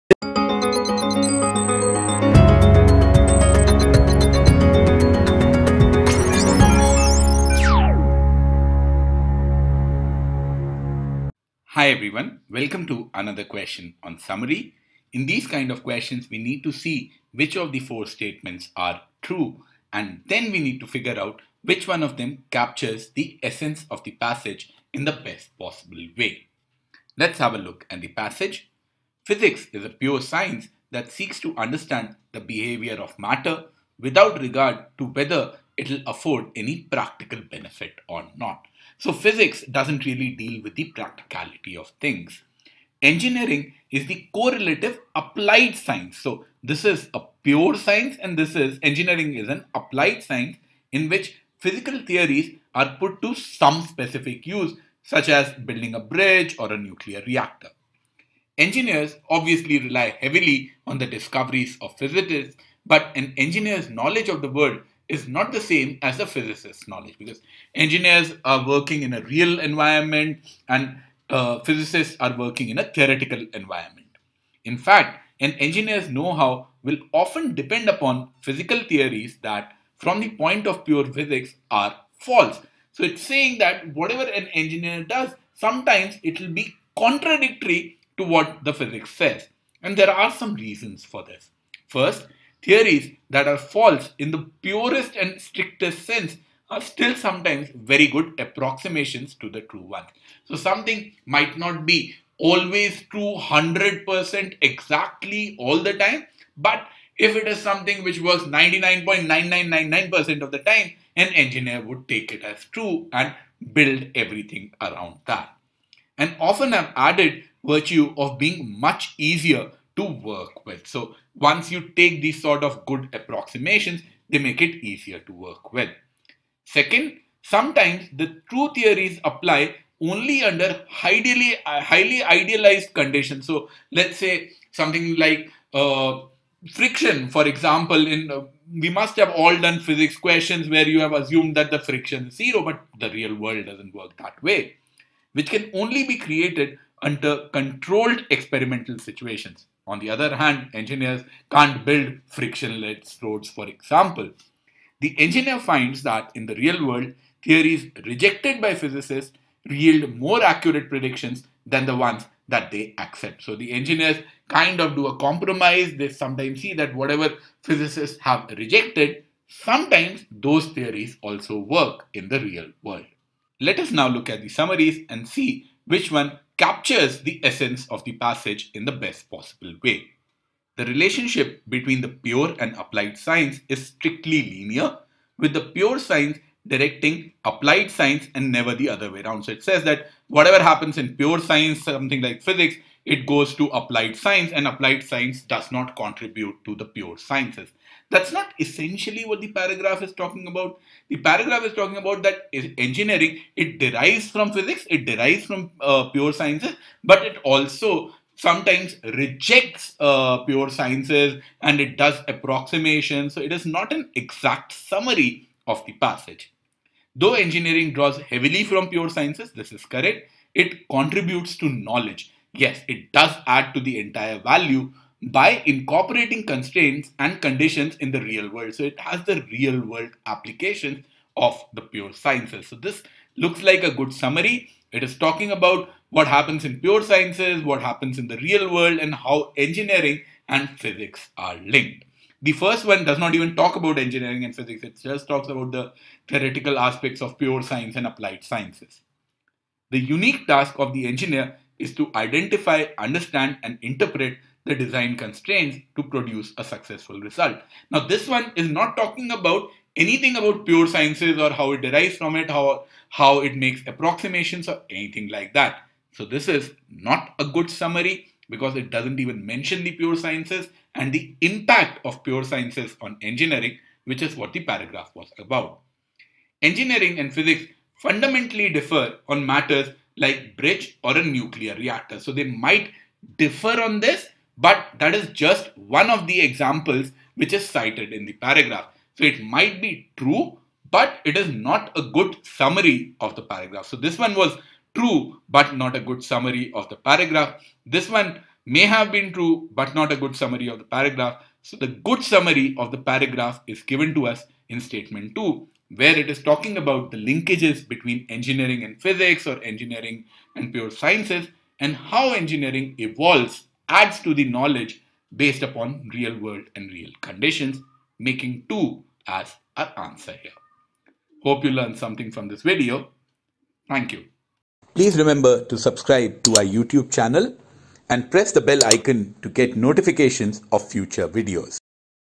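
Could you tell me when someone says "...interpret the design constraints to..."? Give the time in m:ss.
4:13.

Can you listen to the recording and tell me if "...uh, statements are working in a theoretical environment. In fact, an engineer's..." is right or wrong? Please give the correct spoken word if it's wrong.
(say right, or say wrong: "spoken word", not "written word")
wrong: "physicists", not "statements".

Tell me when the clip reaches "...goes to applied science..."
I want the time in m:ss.
3:13.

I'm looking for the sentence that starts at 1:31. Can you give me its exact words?
First, theories that are false in the purest and strictest sense are still sometimes very good approximations to the true ones.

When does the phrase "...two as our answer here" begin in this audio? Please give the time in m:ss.
5:18.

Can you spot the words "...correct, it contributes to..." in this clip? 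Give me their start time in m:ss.
3:39.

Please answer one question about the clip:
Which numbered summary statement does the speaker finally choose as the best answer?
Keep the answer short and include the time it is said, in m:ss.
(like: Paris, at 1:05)
2, at 5:04.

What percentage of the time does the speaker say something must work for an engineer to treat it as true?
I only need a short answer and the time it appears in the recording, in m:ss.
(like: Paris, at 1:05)
99.9999%, at 1:48.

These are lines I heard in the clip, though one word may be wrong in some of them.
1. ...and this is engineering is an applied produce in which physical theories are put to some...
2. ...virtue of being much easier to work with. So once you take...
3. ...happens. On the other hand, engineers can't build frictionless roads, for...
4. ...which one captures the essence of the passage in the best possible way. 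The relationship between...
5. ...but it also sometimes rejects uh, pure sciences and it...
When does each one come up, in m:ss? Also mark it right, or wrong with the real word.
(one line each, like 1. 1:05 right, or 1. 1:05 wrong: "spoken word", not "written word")
1. 0:48 wrong: "science", not "produce"
2. 1:57 right
3. 2:28 wrong: "situations", not "happens"
4. 2:55 right
5. 3:27 right.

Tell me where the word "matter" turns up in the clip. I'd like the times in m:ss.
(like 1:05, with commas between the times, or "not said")
0:33, 4:39.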